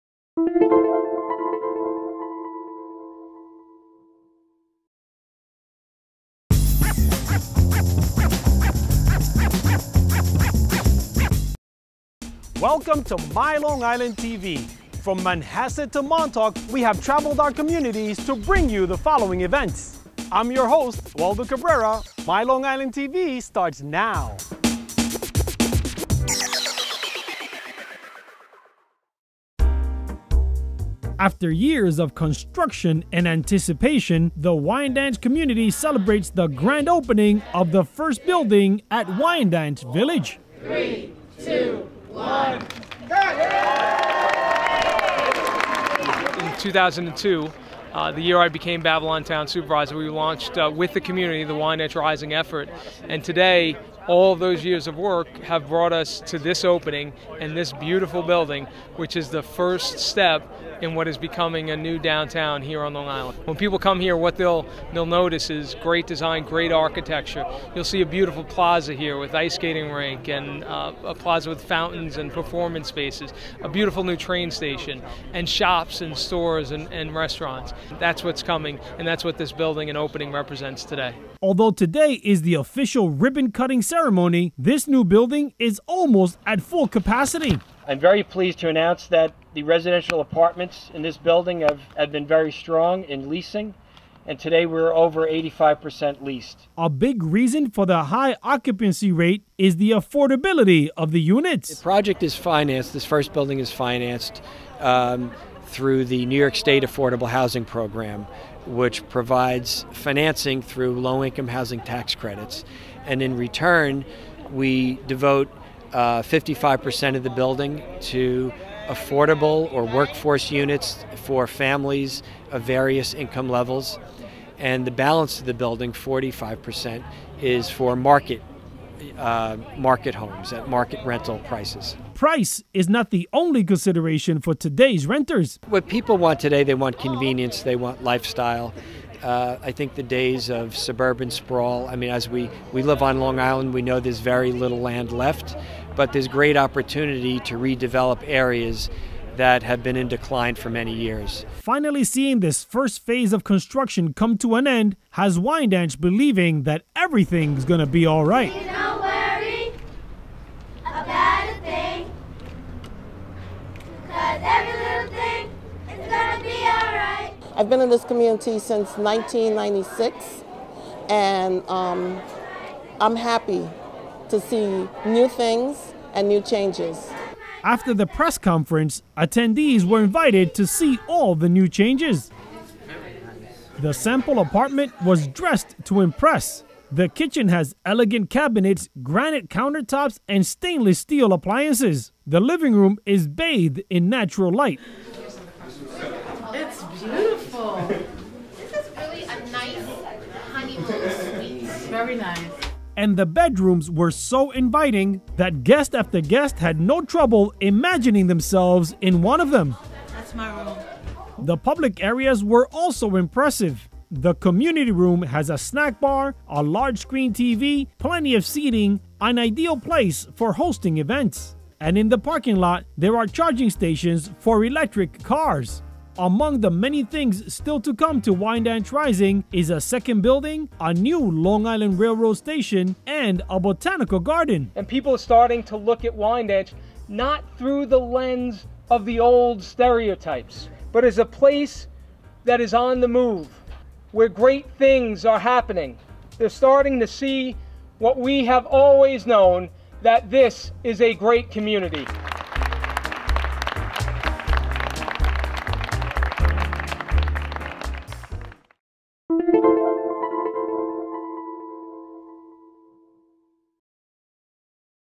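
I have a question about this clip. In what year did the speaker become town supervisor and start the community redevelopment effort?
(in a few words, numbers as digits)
2002.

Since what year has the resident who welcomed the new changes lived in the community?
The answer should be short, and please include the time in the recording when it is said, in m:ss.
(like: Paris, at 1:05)
1996, at 2:48.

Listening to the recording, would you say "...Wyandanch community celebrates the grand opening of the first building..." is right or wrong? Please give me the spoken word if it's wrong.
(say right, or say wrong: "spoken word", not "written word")
right.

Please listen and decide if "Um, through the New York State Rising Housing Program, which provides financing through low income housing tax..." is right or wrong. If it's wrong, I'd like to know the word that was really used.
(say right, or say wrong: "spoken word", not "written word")
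wrong: "Affordable", not "Rising".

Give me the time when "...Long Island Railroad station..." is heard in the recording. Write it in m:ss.
3:51.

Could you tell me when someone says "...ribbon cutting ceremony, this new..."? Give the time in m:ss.
1:23.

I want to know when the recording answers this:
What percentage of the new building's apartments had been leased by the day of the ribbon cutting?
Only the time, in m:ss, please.
1:35.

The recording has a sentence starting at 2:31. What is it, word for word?
Finally, seeing this first phase of construction come to an end has Wyandanch believing that everything's gonna be all right.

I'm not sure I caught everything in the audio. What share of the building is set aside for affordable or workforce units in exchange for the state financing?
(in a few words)
55%.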